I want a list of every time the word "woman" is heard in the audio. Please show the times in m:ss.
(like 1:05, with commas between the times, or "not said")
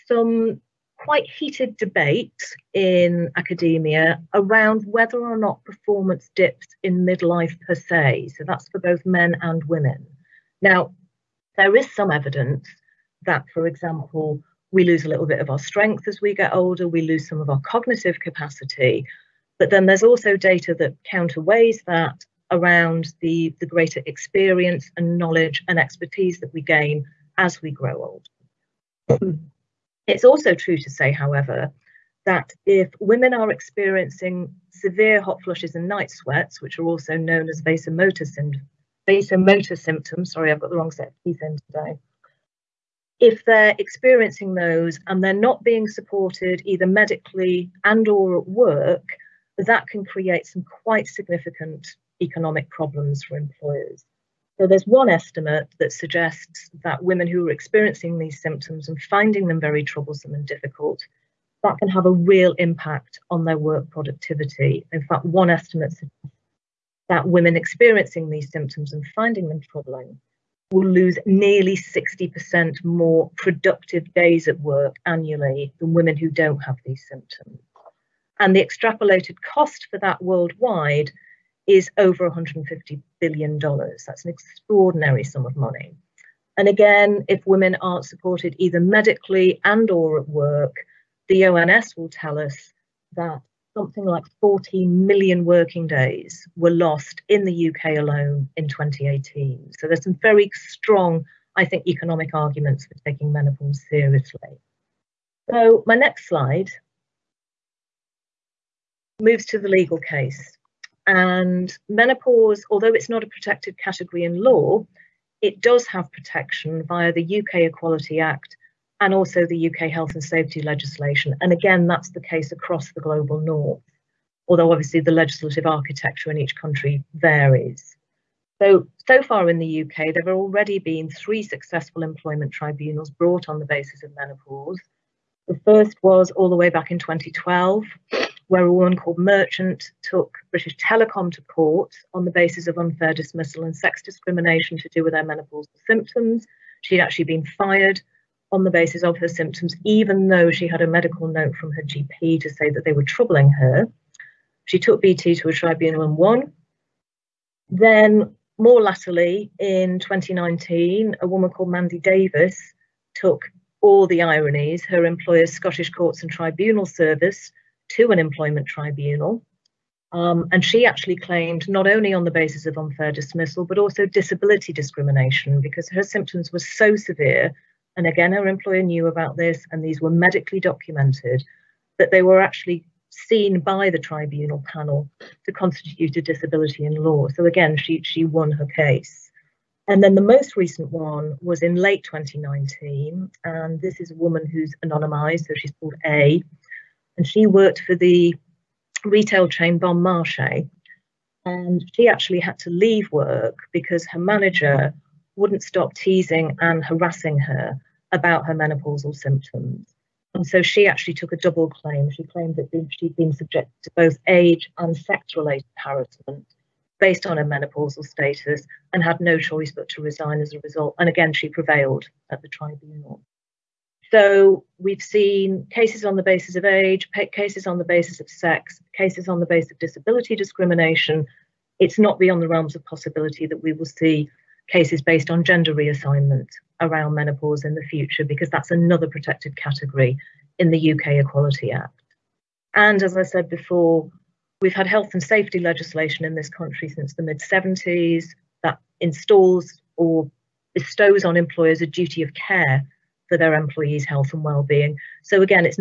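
2:18, 2:41, 3:14.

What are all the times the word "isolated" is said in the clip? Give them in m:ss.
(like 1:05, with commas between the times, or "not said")
not said.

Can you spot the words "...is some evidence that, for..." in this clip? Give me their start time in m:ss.
0:11.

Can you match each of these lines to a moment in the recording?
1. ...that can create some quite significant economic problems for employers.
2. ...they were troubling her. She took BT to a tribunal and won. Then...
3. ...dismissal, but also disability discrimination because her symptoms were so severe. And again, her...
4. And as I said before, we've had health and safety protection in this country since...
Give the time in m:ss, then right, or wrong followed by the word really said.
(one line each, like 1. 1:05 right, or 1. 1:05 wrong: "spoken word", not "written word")
1. 0:49 right
2. 2:32 right
3. 2:53 right
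4. 4:02 wrong: "legislation", not "protection".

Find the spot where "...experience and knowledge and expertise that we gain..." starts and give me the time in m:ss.
0:24.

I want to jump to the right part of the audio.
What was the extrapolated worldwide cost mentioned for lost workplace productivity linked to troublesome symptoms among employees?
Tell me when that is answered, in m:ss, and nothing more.
1:21.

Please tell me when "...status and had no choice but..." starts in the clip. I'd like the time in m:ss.
3:38.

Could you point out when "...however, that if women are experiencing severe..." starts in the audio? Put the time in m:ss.
0:31.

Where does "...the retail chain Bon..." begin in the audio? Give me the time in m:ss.
3:17.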